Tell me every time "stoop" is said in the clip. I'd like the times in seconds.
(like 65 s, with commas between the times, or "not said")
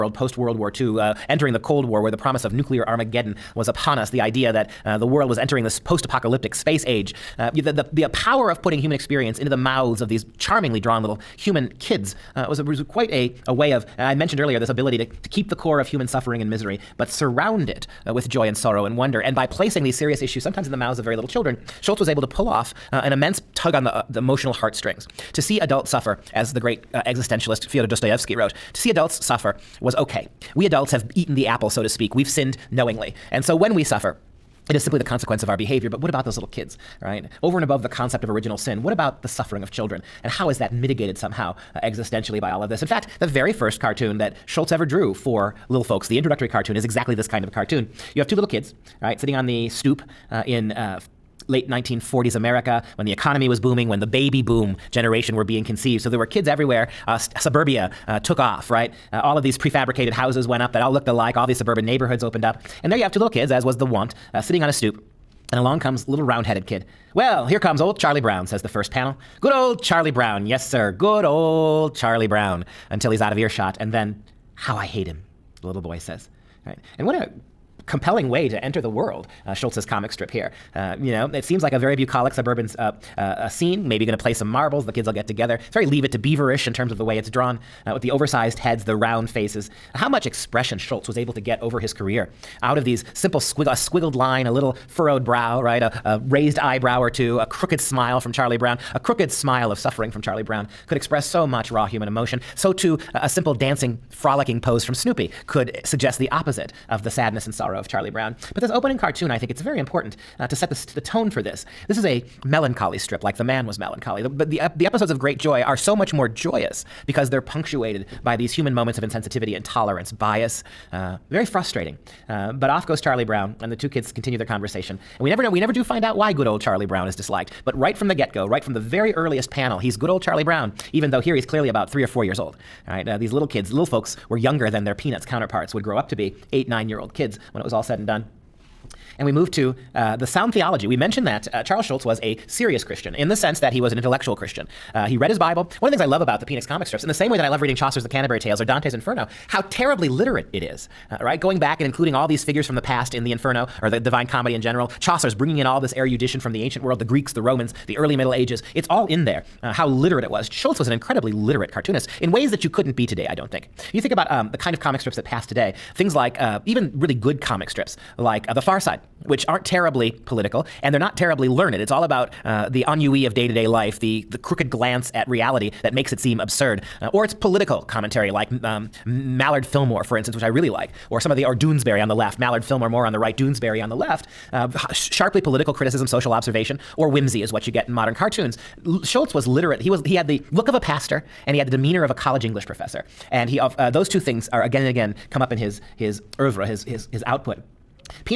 49 s, 64 s.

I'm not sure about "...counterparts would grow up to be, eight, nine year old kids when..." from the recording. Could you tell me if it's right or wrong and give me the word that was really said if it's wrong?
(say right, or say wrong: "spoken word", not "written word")
right.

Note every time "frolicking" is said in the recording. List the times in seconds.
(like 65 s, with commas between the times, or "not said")
104 s.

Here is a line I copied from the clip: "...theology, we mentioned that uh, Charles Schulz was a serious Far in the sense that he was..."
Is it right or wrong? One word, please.
wrong.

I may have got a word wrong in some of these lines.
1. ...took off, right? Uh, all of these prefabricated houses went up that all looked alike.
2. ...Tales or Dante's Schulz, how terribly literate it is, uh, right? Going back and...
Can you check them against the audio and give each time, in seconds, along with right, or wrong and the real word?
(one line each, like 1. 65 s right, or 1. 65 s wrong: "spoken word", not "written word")
1. 58 s right
2. 148 s wrong: "Inferno", not "Schulz".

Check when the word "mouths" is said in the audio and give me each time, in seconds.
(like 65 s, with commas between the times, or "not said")
9 s, 20 s.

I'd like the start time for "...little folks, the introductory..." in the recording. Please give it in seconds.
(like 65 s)
45 s.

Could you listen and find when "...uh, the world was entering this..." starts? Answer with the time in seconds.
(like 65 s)
4 s.